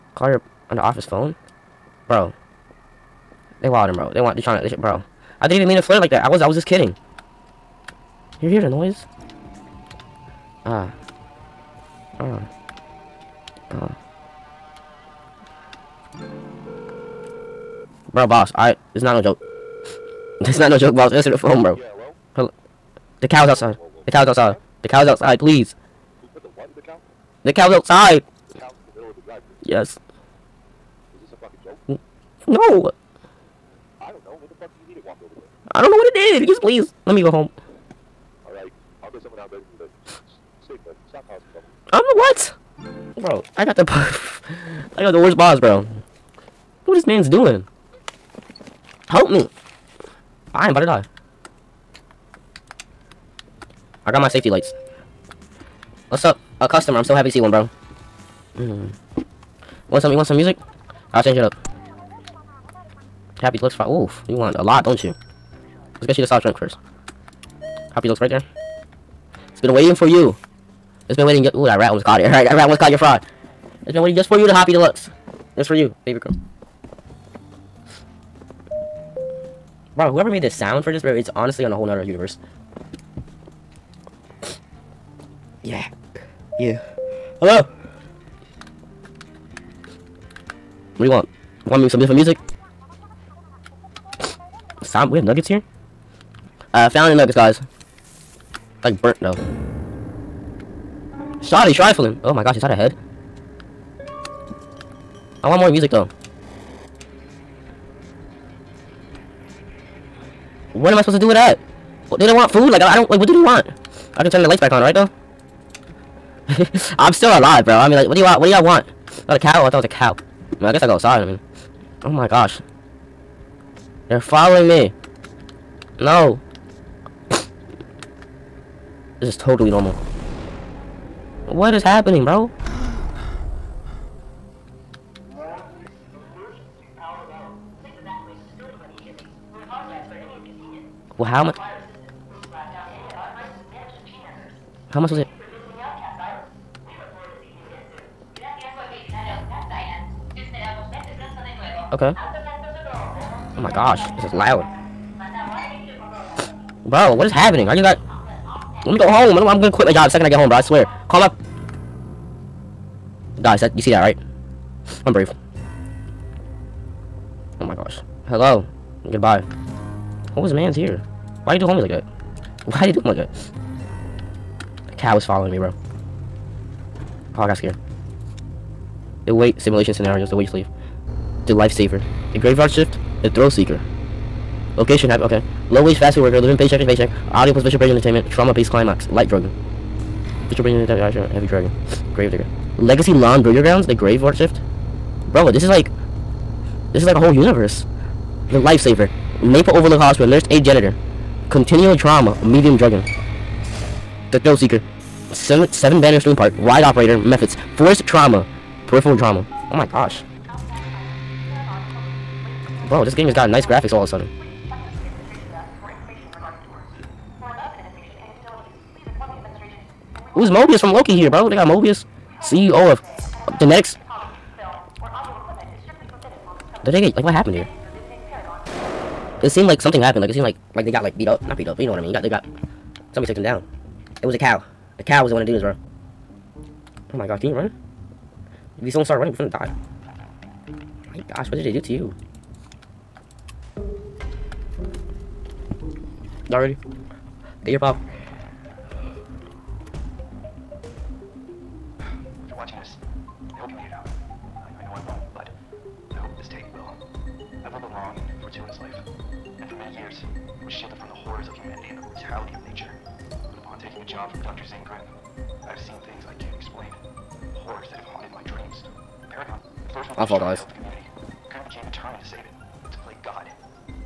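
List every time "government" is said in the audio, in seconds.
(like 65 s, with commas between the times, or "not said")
not said.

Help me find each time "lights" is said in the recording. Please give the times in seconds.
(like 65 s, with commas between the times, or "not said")
54 s, 114 s, 189 s.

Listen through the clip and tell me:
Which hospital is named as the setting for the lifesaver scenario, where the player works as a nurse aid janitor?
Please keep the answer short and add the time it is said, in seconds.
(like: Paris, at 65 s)
Maple Overlook Hospital, at 199 s.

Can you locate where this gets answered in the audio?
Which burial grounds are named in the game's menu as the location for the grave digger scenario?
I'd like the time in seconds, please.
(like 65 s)
192 s.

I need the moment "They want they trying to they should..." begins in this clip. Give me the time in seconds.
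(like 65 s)
4 s.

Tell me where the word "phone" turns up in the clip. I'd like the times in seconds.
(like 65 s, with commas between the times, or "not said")
1 s, 21 s.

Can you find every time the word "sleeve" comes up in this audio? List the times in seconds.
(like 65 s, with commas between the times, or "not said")
180 s.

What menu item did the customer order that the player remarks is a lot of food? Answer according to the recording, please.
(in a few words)
Happy Deluxe Fry.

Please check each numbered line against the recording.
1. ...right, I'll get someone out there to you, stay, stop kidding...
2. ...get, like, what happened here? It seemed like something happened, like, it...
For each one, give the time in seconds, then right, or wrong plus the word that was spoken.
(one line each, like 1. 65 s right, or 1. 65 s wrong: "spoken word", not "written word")
1. 38 s wrong: "causing", not "kidding"
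2. 227 s right.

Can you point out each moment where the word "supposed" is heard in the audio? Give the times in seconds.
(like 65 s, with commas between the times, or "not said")
111 s.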